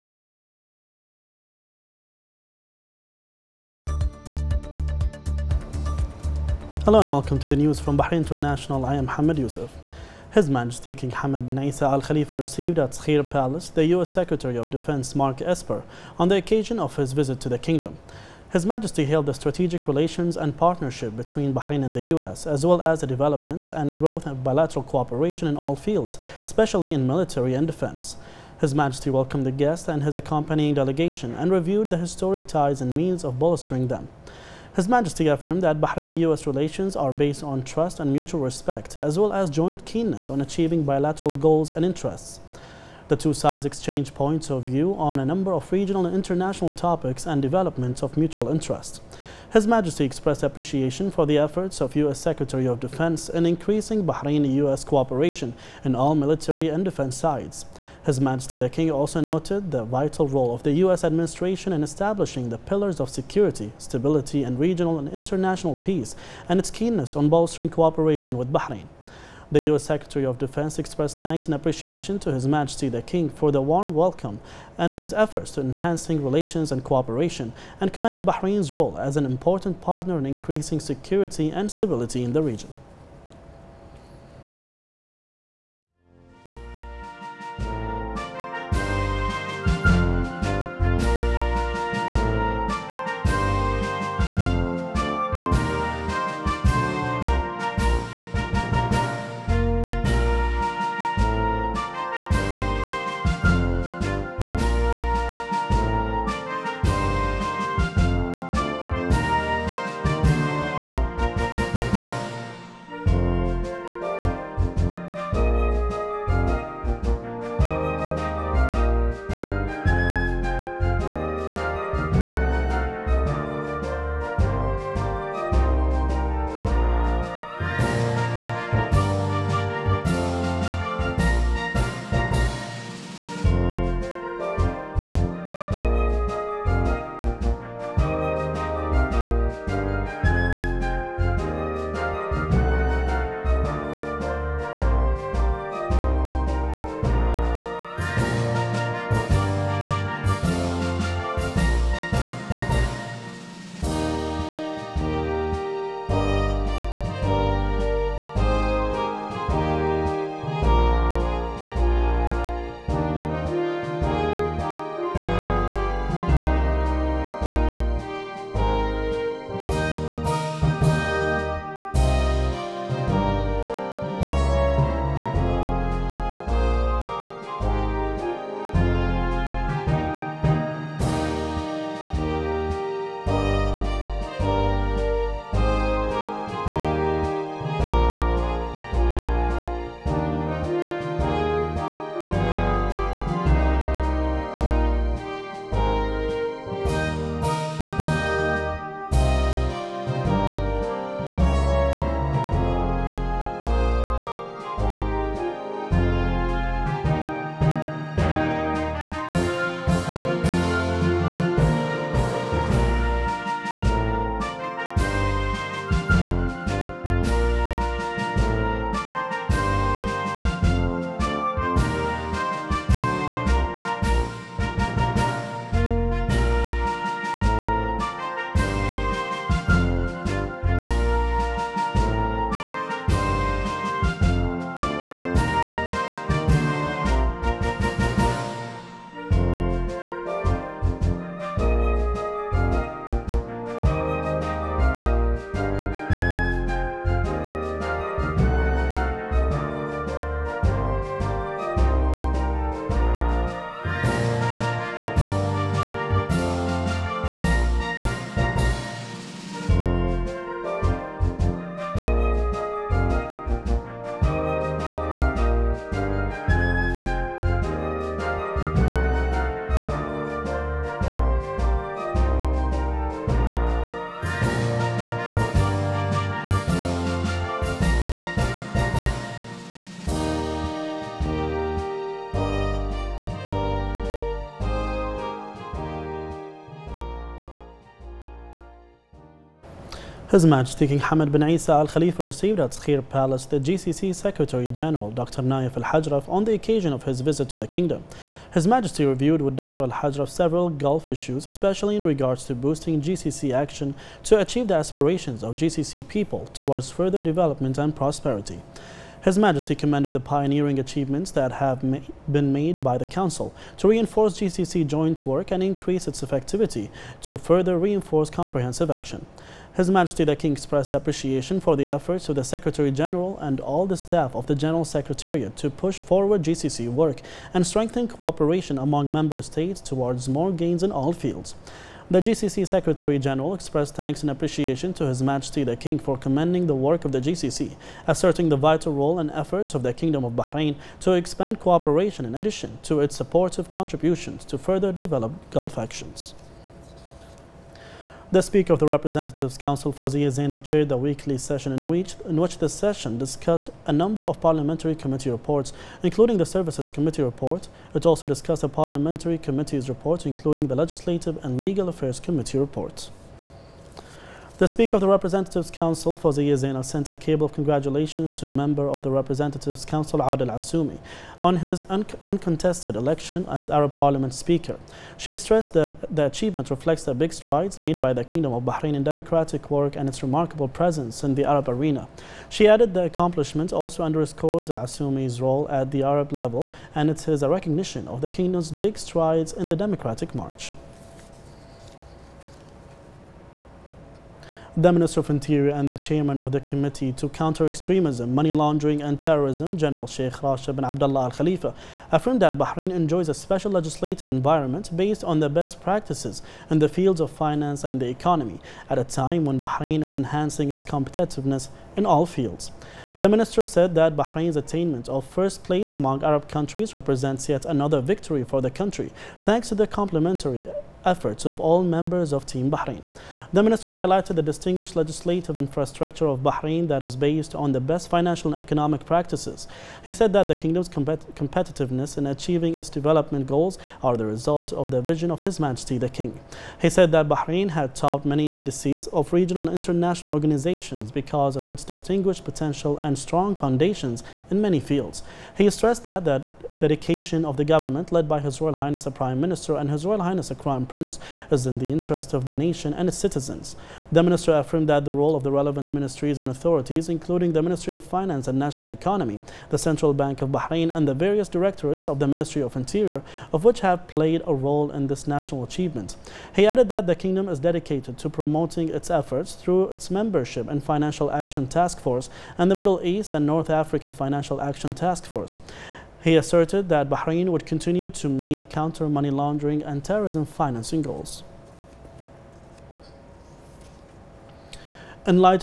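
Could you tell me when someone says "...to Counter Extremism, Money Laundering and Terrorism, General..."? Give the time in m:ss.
6:37.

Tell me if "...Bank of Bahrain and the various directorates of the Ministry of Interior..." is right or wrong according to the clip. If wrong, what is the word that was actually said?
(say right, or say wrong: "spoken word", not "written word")
right.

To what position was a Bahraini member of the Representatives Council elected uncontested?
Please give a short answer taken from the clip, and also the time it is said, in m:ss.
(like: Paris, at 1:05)
Arab Parliament Speaker, at 6:13.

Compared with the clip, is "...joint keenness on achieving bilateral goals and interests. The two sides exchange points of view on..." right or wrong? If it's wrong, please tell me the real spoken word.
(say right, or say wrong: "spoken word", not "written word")
right.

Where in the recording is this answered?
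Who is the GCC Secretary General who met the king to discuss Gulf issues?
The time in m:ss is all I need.
4:55.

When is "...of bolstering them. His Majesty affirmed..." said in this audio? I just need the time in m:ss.
0:33.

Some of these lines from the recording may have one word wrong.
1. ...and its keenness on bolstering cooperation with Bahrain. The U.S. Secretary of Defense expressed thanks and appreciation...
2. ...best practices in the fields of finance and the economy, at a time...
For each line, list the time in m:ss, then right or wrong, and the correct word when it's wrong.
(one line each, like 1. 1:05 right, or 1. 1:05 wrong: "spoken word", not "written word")
1. 1:06 right
2. 6:45 right.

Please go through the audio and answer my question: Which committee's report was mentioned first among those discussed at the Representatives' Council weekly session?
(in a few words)
Services Committee.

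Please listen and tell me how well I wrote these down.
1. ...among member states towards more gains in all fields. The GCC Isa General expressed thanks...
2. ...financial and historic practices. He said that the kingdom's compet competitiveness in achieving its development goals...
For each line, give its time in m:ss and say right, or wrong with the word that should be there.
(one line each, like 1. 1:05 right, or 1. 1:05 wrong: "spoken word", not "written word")
1. 5:28 wrong: "Secretary", not "Isa"
2. 7:08 wrong: "economic", not "historic".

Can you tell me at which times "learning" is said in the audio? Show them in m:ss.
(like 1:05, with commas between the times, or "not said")
not said.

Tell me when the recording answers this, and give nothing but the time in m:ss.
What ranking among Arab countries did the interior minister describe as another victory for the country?
6:55.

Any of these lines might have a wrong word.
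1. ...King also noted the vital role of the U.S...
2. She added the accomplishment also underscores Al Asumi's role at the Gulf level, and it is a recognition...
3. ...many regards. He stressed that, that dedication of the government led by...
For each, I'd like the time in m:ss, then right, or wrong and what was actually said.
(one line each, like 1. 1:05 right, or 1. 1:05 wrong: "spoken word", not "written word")
1. 0:58 right
2. 6:22 wrong: "Arab", not "Gulf"
3. 7:24 wrong: "fields", not "regards".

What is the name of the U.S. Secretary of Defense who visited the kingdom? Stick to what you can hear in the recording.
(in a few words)
Mark Esper.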